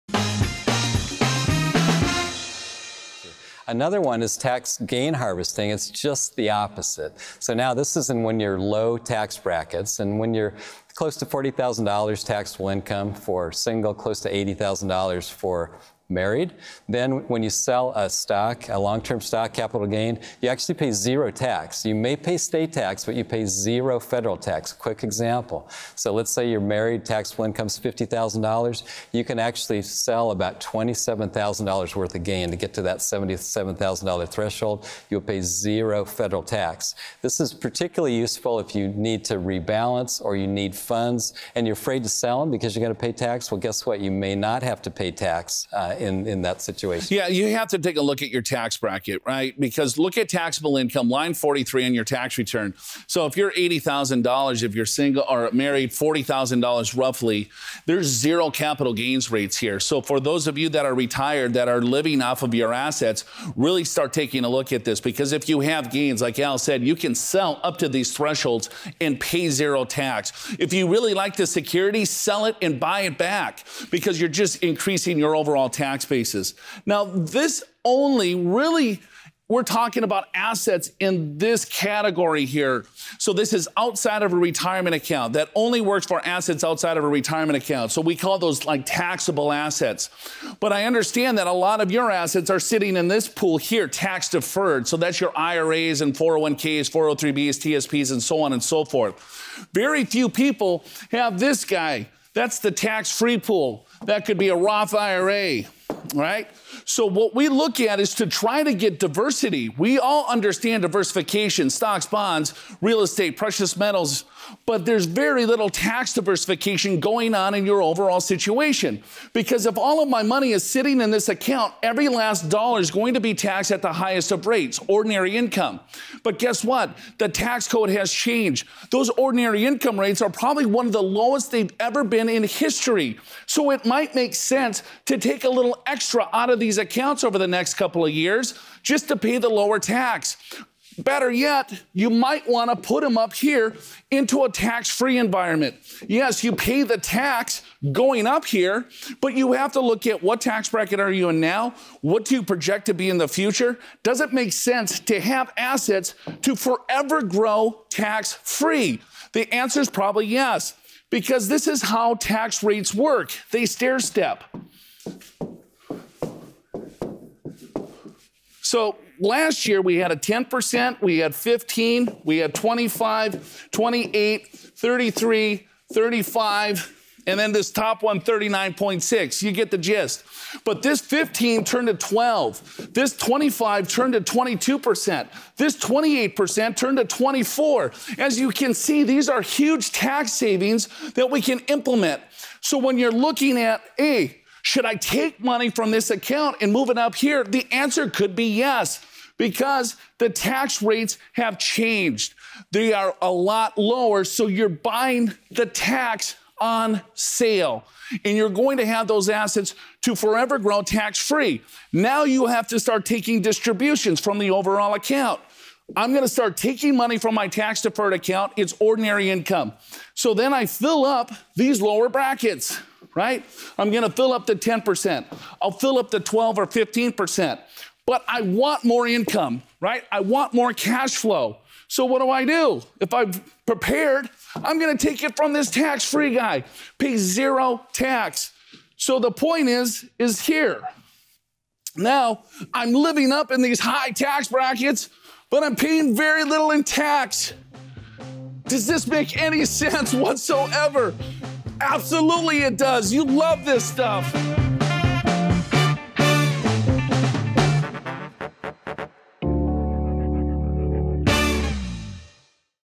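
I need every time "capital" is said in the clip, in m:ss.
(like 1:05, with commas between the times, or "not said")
0:19, 0:58.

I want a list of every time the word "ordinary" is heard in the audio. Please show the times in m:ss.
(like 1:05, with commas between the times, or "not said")
2:04, 2:09, 3:38.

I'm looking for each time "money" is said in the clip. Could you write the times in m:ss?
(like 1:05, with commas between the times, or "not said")
2:00, 3:15, 3:36.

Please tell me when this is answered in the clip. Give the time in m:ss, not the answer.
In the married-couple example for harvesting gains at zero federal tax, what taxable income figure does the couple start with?
0:27.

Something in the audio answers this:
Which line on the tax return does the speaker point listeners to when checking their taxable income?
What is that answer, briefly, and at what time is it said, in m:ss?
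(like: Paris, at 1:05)
Line 43, at 0:51.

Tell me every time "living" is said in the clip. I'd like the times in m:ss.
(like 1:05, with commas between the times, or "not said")
1:01, 4:02.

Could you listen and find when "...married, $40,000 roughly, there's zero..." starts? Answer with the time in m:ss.
0:55.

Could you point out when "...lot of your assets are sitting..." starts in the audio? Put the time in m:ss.
1:31.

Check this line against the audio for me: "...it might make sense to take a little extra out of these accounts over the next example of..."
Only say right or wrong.
wrong.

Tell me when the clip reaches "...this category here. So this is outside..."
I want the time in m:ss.
1:21.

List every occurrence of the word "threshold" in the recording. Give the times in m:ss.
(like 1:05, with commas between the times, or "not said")
0:34, 1:08.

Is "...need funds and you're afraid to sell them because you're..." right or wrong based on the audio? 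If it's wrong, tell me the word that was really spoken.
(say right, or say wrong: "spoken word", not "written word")
right.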